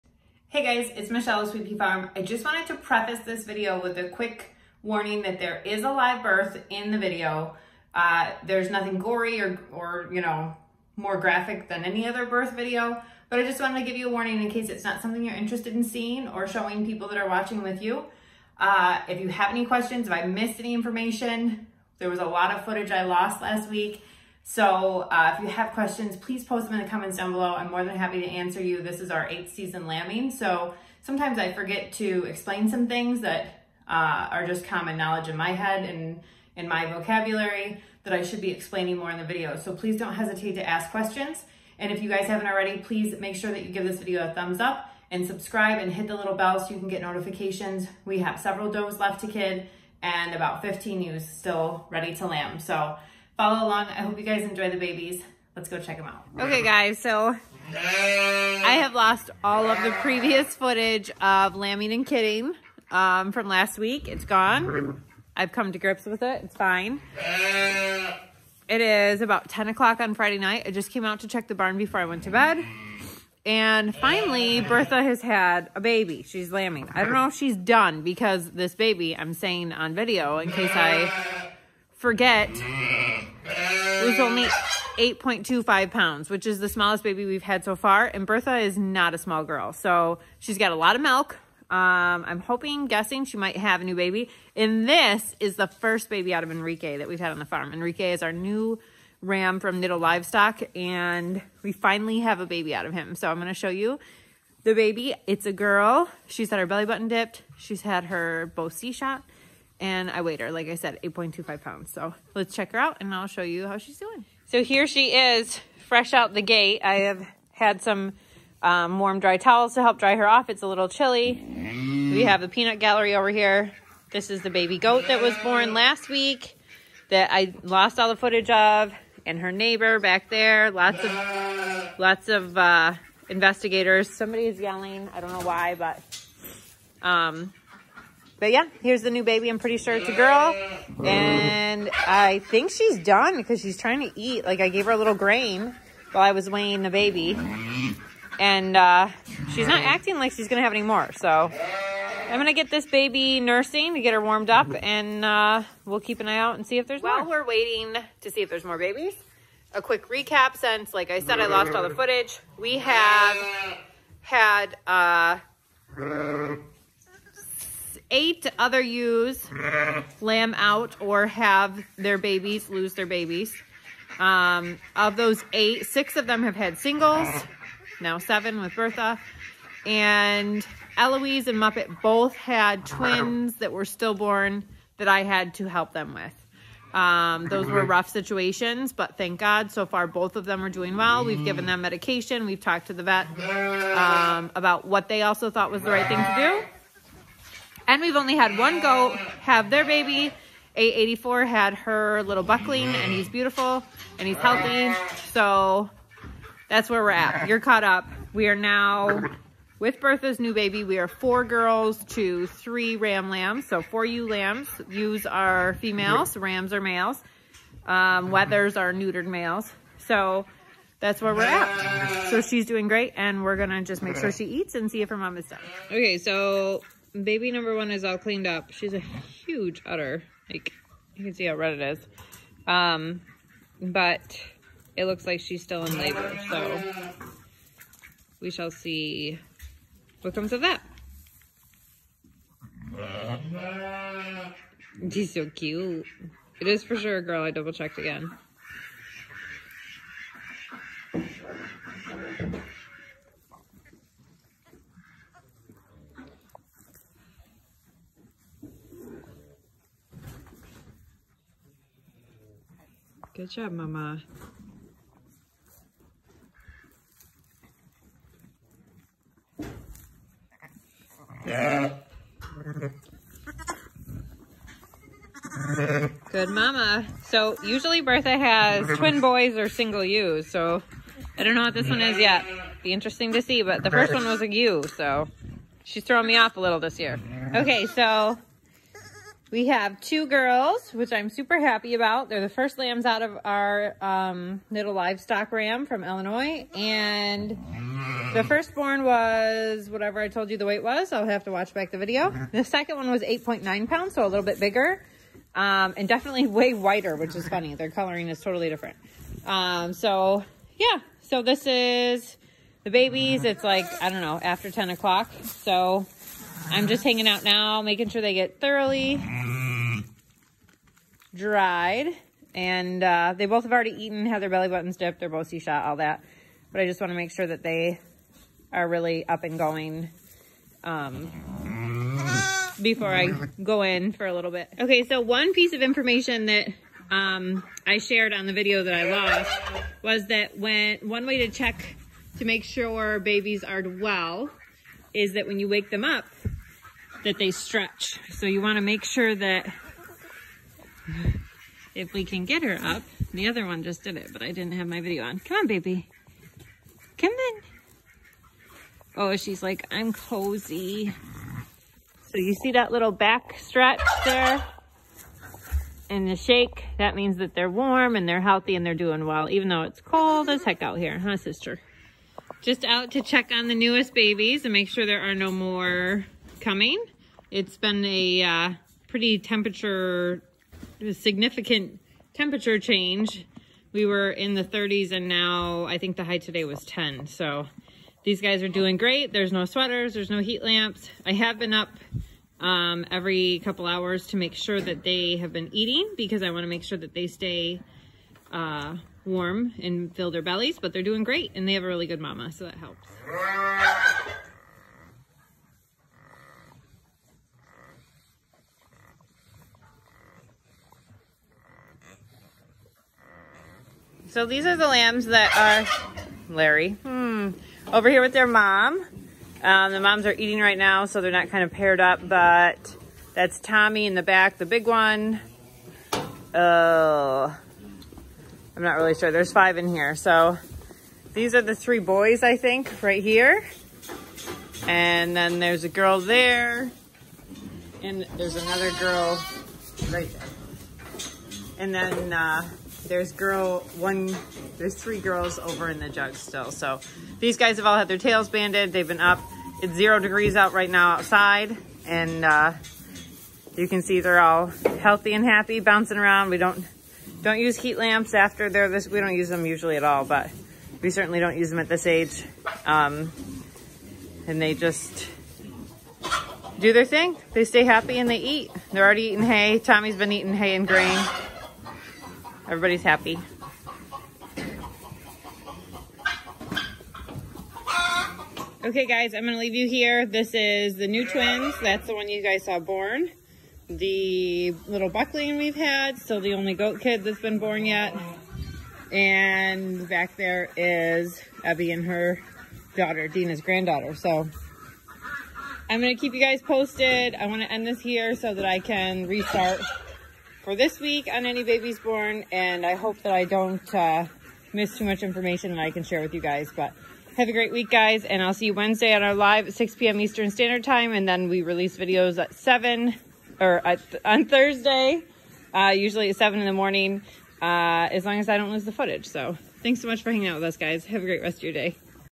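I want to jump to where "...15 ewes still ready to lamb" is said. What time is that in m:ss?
0:50.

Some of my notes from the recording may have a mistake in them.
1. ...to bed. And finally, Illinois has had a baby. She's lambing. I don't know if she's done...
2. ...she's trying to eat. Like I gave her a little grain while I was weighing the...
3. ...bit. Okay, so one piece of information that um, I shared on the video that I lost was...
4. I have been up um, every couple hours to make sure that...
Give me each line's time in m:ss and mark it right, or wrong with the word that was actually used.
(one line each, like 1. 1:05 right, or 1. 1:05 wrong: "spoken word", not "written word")
1. 1:12 wrong: "Bertha", not "Illinois"
2. 2:23 right
3. 5:34 right
4. 6:31 right.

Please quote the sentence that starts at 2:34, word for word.
And uh, we'll keep an eye out and see if there's While more.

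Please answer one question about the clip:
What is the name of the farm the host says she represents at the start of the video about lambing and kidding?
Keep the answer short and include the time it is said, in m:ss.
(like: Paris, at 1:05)
Sweet Farm, at 0:01.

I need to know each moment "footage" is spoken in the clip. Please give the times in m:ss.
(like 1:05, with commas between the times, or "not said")
0:22, 1:00, 2:08, 2:41, 8:38.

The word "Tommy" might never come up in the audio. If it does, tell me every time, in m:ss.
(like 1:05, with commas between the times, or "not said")
7:03, 7:49.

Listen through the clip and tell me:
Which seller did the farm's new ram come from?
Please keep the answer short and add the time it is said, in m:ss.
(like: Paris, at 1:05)
Niddle Livestock, at 1:39.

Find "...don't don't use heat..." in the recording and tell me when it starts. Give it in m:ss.
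7:36.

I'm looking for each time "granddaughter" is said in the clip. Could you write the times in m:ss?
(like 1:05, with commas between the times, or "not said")
8:13.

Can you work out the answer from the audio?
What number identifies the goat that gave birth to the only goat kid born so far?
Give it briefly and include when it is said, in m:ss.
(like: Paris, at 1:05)
884, at 3:20.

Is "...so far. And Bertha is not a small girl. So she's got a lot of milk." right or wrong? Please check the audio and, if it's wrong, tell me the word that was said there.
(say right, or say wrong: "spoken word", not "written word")
right.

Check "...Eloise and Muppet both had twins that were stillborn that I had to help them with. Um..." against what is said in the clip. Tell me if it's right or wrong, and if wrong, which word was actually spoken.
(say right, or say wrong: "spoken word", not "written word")
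right.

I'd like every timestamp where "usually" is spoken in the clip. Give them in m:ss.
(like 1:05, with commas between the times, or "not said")
4:37, 7:39, 8:35.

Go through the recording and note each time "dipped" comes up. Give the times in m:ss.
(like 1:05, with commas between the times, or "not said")
1:47, 5:24.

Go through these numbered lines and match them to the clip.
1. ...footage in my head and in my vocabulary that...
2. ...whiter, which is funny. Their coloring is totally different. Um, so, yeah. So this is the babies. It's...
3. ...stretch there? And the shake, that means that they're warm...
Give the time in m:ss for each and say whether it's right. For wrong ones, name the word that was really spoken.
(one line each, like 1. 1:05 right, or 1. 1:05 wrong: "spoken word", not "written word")
1. 0:34 wrong: "knowledge", not "footage"
2. 5:06 right
3. 6:03 right.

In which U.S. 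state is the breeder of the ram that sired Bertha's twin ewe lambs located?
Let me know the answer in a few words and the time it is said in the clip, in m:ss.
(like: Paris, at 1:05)
Illinois, at 4:56.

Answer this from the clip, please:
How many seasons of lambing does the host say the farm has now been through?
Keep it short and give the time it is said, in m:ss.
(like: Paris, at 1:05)
8, at 0:29.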